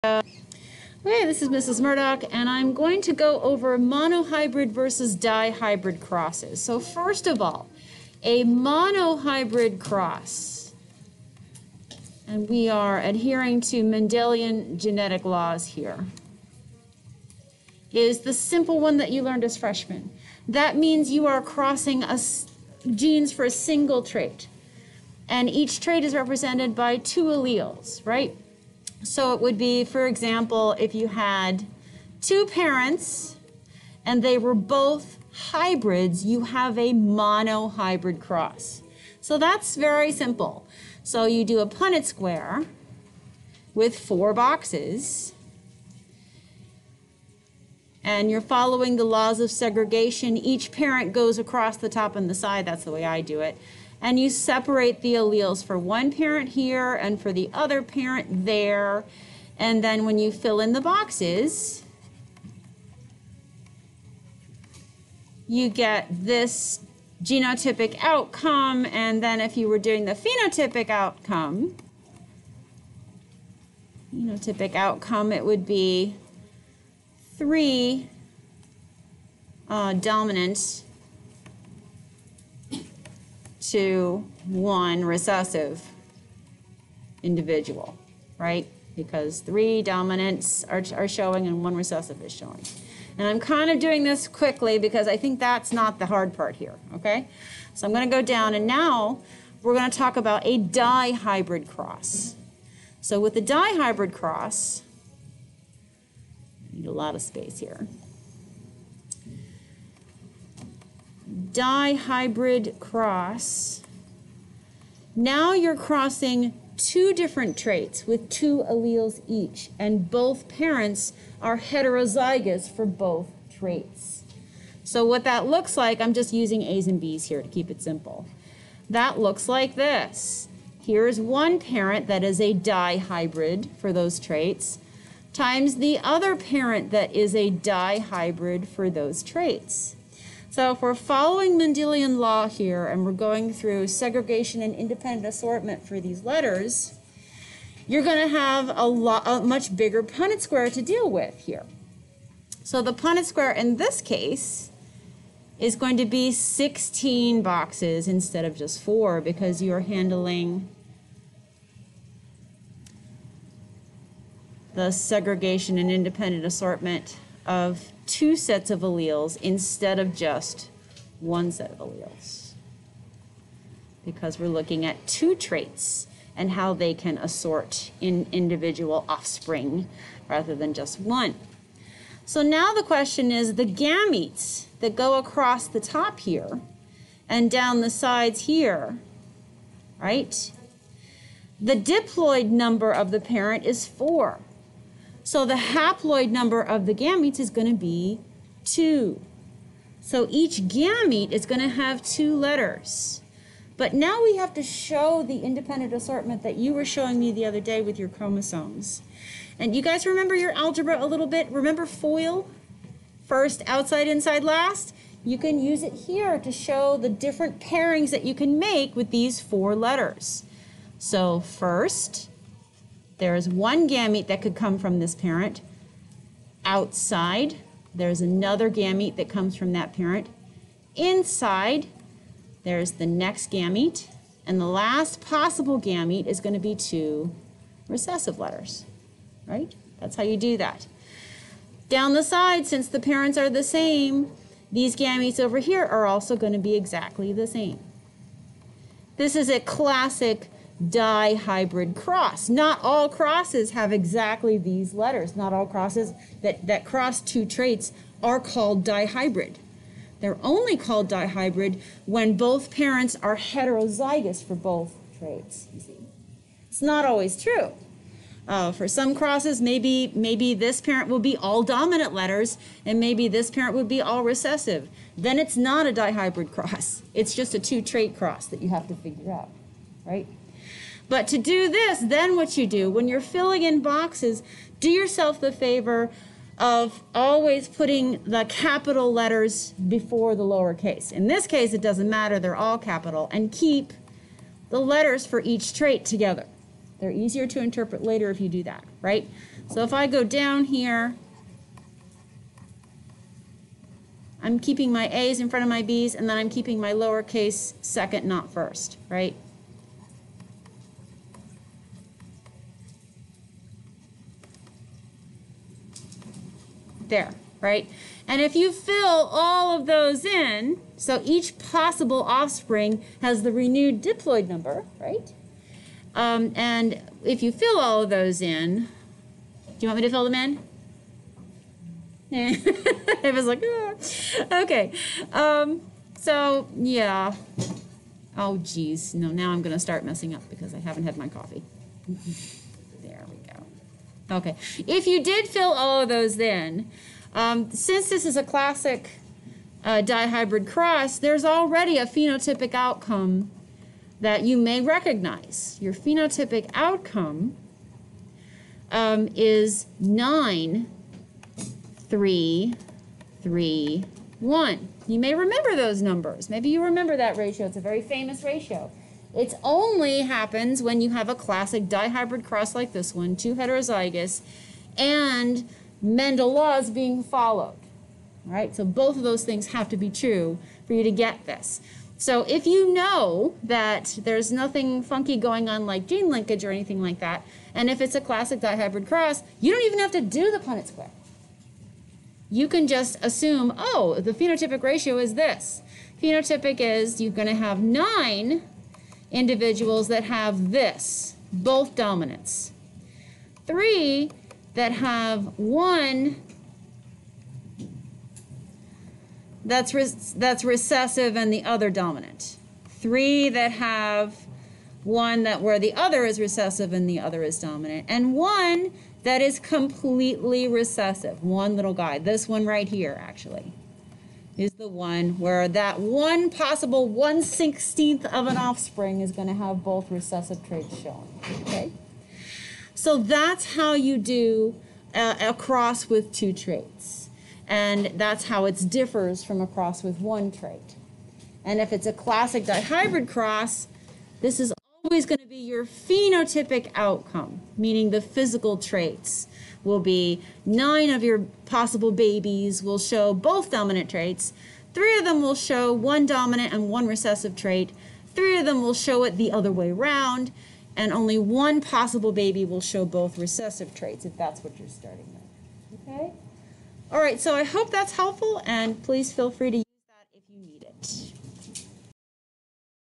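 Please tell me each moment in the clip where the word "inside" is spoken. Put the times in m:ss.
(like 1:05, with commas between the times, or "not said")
3:34, 3:50.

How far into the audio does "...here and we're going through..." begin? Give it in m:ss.
2:22.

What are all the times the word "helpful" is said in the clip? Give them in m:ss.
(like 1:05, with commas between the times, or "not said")
7:48.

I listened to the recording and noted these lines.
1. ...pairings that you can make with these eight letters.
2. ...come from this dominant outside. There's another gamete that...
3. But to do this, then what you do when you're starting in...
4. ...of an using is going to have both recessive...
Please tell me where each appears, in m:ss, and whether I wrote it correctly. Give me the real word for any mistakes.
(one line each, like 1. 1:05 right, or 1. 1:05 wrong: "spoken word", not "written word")
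1. 3:37 wrong: "four", not "eight"
2. 3:44 wrong: "parent", not "dominant"
3. 4:41 wrong: "filling", not "starting"
4. 7:08 wrong: "offspring", not "using".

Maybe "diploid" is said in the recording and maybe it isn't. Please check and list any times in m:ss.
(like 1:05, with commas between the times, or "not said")
3:11, 5:24.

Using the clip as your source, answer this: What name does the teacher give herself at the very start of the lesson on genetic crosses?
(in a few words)
Mrs. Murdock.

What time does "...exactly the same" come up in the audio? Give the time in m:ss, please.
4:06.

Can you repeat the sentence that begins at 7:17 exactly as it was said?
And that's how it differs from a cross with one trait.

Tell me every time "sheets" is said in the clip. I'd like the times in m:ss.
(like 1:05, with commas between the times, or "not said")
not said.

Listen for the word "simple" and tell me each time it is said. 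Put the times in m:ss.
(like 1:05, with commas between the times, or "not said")
0:18, 0:40, 2:07.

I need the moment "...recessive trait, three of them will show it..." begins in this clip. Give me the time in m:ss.
7:37.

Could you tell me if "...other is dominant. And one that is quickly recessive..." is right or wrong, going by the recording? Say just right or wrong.
wrong.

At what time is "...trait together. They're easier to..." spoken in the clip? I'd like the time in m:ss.
4:55.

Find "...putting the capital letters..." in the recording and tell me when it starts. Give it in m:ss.
4:47.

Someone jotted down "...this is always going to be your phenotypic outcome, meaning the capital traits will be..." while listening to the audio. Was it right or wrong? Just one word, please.
wrong.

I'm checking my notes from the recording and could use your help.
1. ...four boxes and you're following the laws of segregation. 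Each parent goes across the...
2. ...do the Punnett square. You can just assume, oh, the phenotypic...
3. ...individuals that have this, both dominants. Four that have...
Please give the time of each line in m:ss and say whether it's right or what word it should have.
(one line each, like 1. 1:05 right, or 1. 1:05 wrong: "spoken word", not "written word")
1. 0:43 right
2. 6:30 right
3. 6:39 wrong: "Three", not "Four".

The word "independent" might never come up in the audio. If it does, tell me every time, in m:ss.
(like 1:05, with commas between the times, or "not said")
2:24, 2:45, 3:25.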